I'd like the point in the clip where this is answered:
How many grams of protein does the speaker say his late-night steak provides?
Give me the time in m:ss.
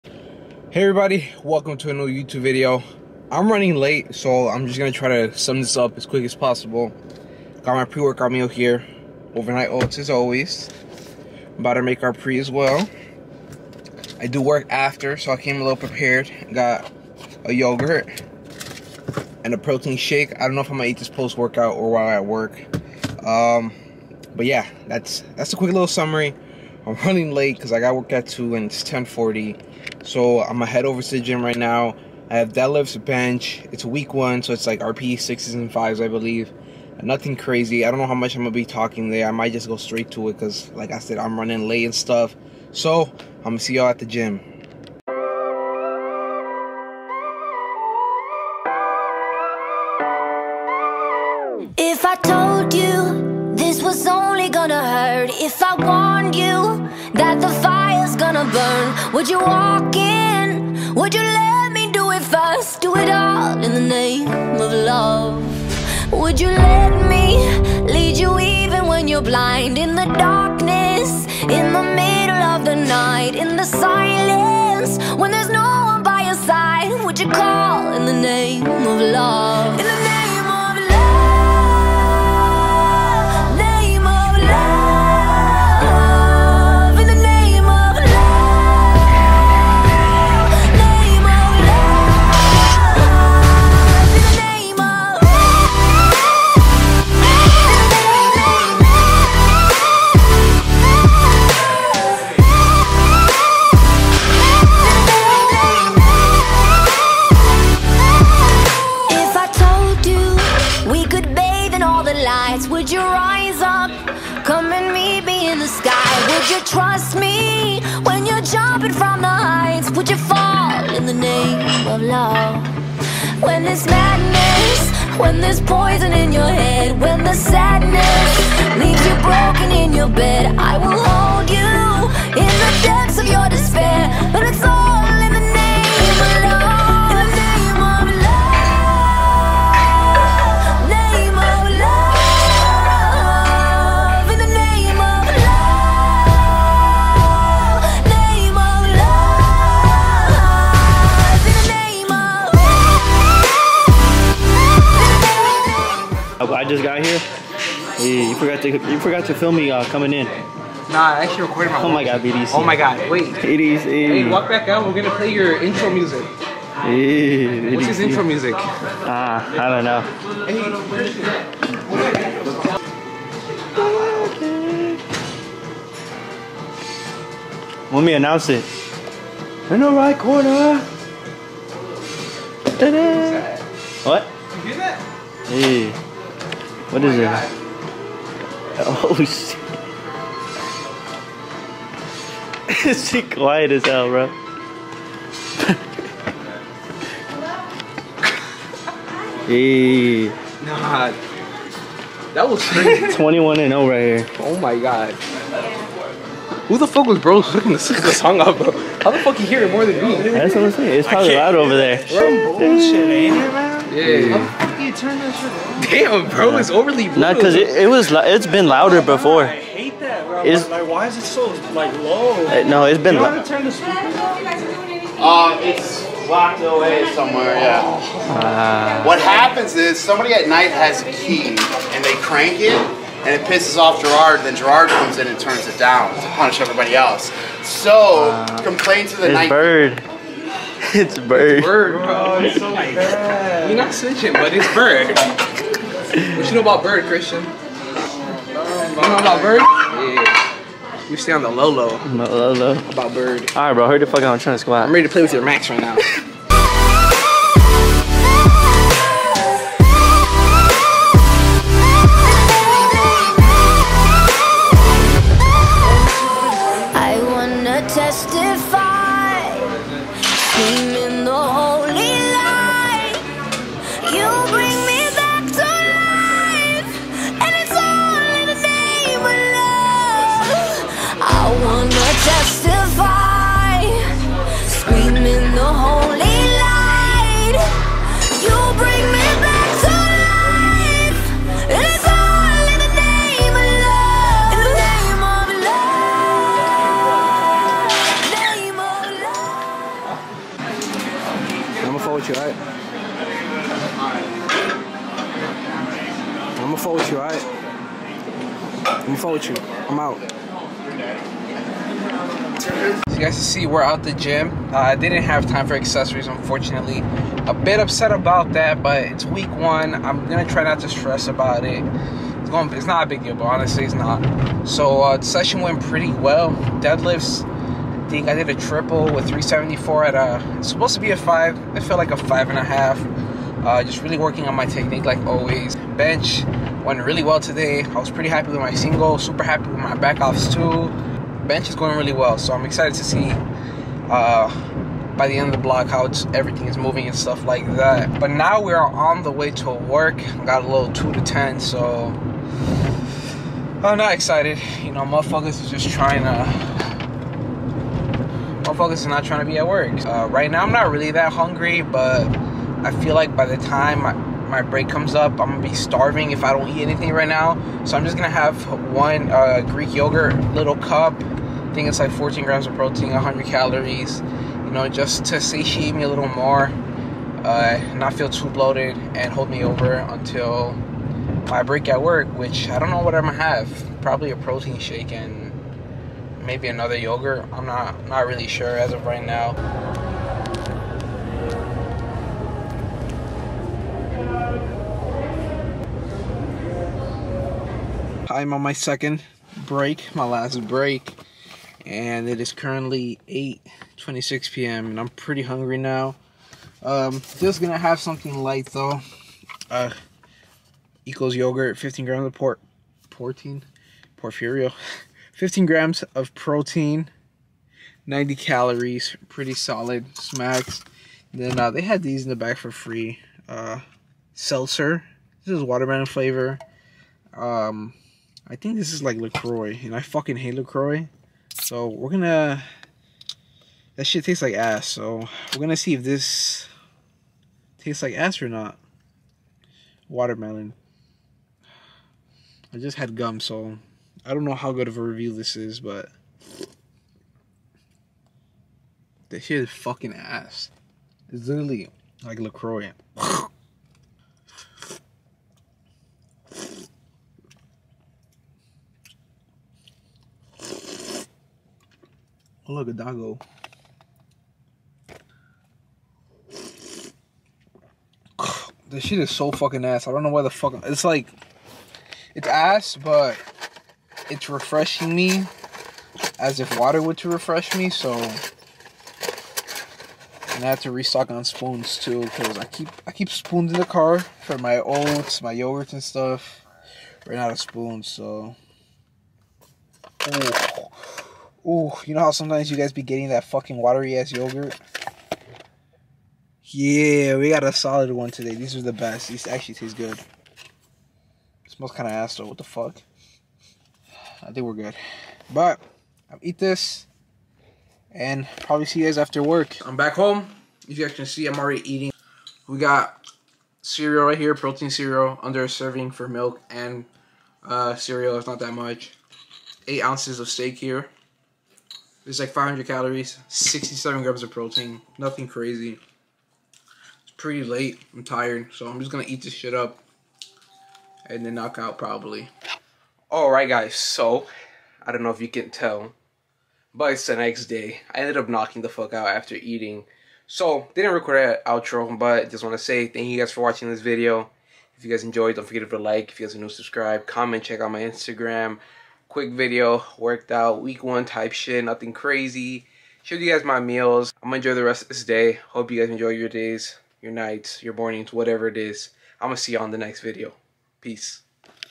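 8:43.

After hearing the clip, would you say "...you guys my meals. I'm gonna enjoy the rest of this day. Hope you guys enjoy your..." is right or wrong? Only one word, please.
right.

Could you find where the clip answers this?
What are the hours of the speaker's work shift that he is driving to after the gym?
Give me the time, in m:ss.
5:50.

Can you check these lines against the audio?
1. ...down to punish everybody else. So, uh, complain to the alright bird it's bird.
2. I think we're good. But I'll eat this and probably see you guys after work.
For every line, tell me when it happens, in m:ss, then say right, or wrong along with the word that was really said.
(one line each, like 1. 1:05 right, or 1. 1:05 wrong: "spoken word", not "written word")
1. 3:55 wrong: "night", not "alright"
2. 8:24 right.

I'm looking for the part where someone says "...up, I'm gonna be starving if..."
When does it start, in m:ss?
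6:05.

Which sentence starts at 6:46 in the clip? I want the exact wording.
Um, just gonna have something light though.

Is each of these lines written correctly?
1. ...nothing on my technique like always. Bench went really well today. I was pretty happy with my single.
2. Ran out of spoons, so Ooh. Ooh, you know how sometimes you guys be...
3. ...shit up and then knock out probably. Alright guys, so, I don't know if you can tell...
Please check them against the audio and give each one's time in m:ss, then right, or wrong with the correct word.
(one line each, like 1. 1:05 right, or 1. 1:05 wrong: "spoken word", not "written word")
1. 5:34 wrong: "working", not "nothing"
2. 8:07 right
3. 8:49 right.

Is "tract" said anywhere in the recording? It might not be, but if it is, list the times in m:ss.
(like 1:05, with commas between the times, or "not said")
not said.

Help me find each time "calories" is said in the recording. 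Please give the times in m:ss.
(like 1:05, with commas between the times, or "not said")
6:13, 6:58, 8:42.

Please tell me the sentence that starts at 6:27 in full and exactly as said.
I'm not not really sure as of right now.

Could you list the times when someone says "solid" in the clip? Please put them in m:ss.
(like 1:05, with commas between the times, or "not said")
6:59, 8:17.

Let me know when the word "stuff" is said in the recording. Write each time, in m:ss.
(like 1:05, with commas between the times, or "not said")
0:41, 5:47, 8:06.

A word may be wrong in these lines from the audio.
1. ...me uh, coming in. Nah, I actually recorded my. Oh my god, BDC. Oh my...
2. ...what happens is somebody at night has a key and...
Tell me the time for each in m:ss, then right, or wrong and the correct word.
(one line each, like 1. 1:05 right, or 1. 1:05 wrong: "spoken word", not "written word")
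1. 2:39 right
2. 3:49 right.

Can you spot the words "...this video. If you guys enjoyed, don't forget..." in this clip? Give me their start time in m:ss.
9:03.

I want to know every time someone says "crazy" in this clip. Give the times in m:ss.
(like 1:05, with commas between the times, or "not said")
0:37, 3:22, 8:45, 9:12.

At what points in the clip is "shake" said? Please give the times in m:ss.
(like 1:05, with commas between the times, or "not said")
0:19, 6:24.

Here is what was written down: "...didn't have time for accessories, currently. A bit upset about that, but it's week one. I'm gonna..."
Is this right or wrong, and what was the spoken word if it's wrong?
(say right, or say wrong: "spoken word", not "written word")
wrong: "unfortunately", not "currently".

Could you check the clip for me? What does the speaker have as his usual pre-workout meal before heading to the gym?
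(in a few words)
Overnight oats.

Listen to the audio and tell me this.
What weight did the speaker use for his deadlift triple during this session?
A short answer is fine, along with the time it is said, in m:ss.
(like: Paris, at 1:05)
374, at 5:29.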